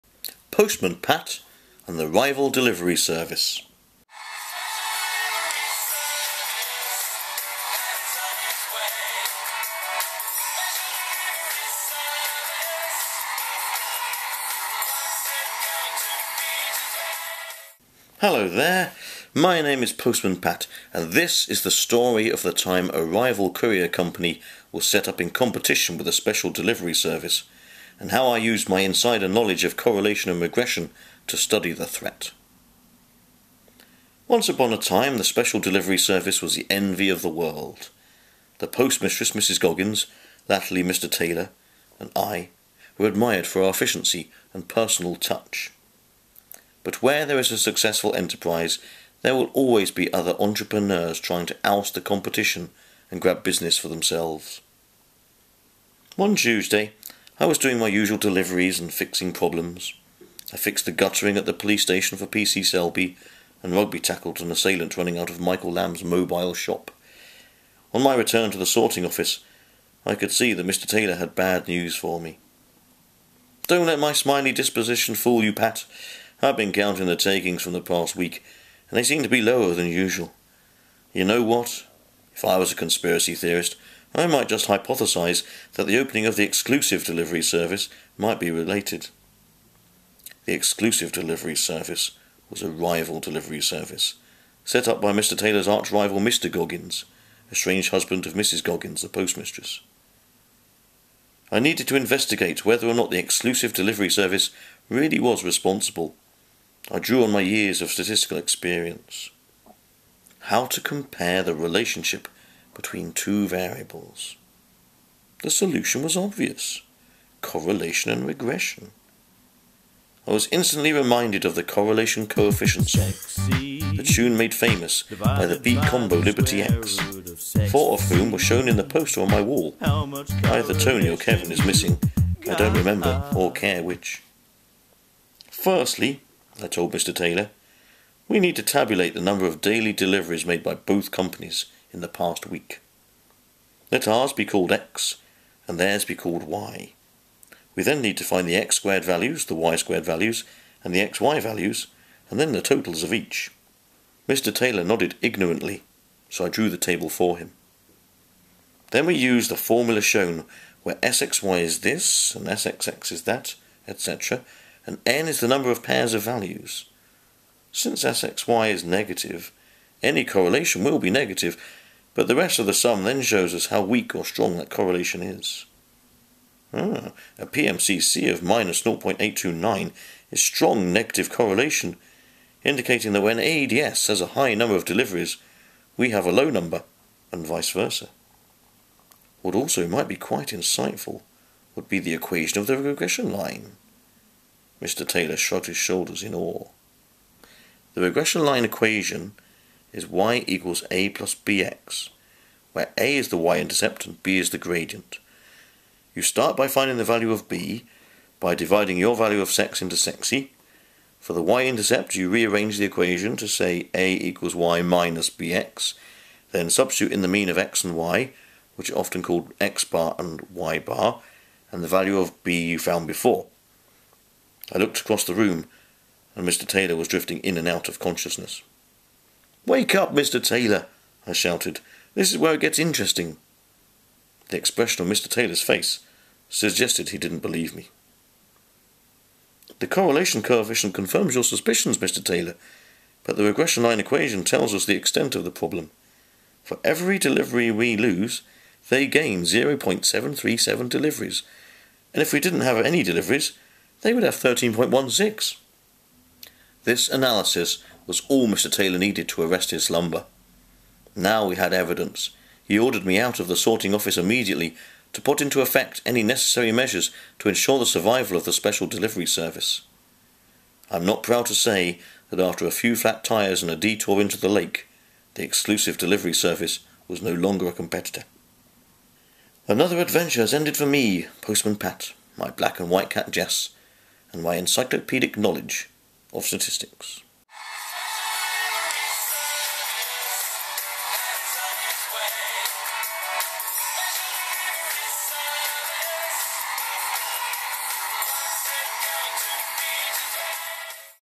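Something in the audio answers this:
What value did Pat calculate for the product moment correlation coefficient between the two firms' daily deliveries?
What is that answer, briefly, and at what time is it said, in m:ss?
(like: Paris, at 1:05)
-0.829, at 2:58.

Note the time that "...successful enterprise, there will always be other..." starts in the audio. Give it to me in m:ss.
0:47.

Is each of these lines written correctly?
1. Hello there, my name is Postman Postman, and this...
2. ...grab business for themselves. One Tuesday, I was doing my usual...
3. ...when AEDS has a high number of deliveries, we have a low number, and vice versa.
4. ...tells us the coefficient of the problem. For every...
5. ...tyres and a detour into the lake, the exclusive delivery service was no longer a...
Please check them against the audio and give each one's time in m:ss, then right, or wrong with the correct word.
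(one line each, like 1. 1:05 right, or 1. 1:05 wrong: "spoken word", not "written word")
1. 0:18 wrong: "Pat", not "Postman"
2. 0:53 right
3. 3:03 right
4. 4:04 wrong: "extent", not "coefficient"
5. 4:33 right.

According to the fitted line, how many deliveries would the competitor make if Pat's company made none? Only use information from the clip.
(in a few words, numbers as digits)
13.16.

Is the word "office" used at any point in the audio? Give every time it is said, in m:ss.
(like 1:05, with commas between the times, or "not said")
1:09, 4:23.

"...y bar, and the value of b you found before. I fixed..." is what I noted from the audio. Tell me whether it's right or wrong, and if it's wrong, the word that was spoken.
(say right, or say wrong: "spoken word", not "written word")
wrong: "looked", not "fixed".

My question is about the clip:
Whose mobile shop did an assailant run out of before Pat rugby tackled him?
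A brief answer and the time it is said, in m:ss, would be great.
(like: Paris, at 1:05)
Michael Lamb, at 1:05.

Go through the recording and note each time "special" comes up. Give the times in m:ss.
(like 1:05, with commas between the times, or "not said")
0:26, 0:35, 4:28.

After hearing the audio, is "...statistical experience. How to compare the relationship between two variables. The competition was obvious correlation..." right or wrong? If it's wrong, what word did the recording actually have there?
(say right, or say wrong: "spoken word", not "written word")
wrong: "solution", not "competition".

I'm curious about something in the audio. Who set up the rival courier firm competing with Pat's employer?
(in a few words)
Mr. Goggins.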